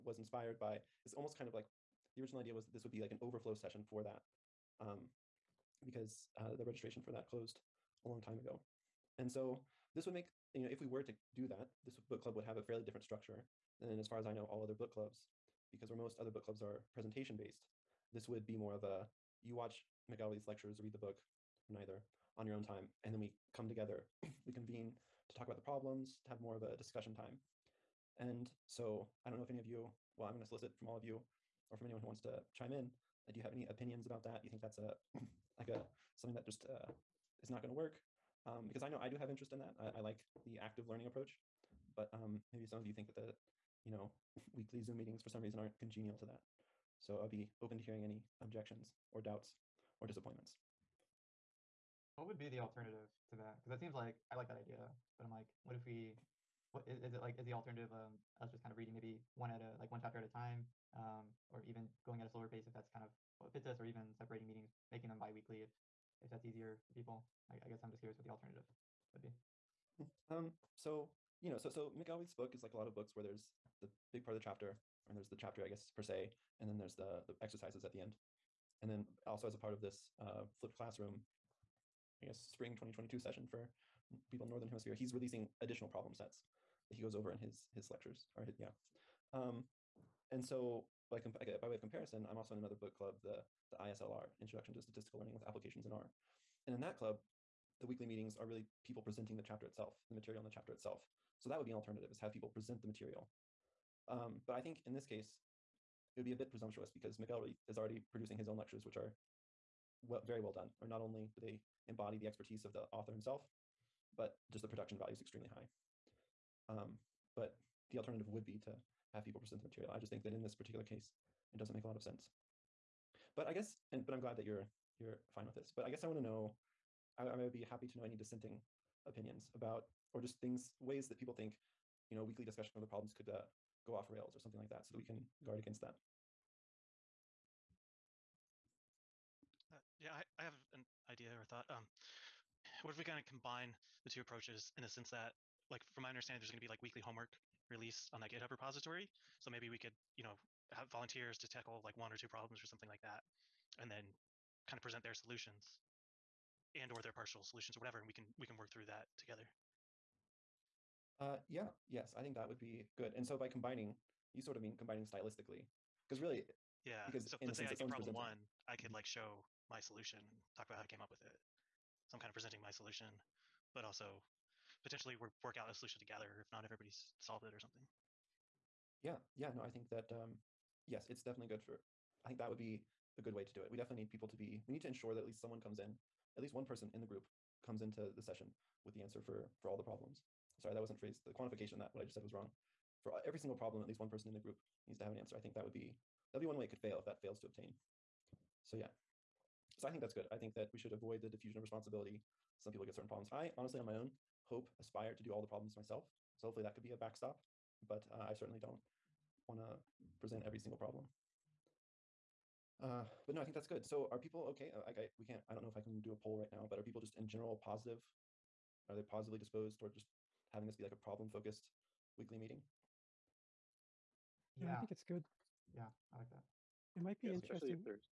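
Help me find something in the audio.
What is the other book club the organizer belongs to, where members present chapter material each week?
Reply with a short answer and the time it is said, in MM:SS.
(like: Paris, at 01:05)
ISLR, at 01:33.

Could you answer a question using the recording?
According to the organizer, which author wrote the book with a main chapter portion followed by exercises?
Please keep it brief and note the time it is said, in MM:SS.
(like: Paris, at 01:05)
McElway, at 01:11.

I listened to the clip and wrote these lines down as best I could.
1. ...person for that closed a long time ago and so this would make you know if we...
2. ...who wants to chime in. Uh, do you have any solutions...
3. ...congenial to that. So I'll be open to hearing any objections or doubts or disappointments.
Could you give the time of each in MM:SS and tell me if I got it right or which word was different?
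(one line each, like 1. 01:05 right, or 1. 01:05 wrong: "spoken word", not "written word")
1. 00:06 wrong: "registration", not "person"
2. 00:32 wrong: "opinions", not "solutions"
3. 00:45 right.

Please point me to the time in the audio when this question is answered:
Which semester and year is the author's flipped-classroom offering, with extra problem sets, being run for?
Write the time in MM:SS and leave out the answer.
01:22.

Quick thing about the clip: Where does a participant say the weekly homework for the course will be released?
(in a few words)
GitHub repository.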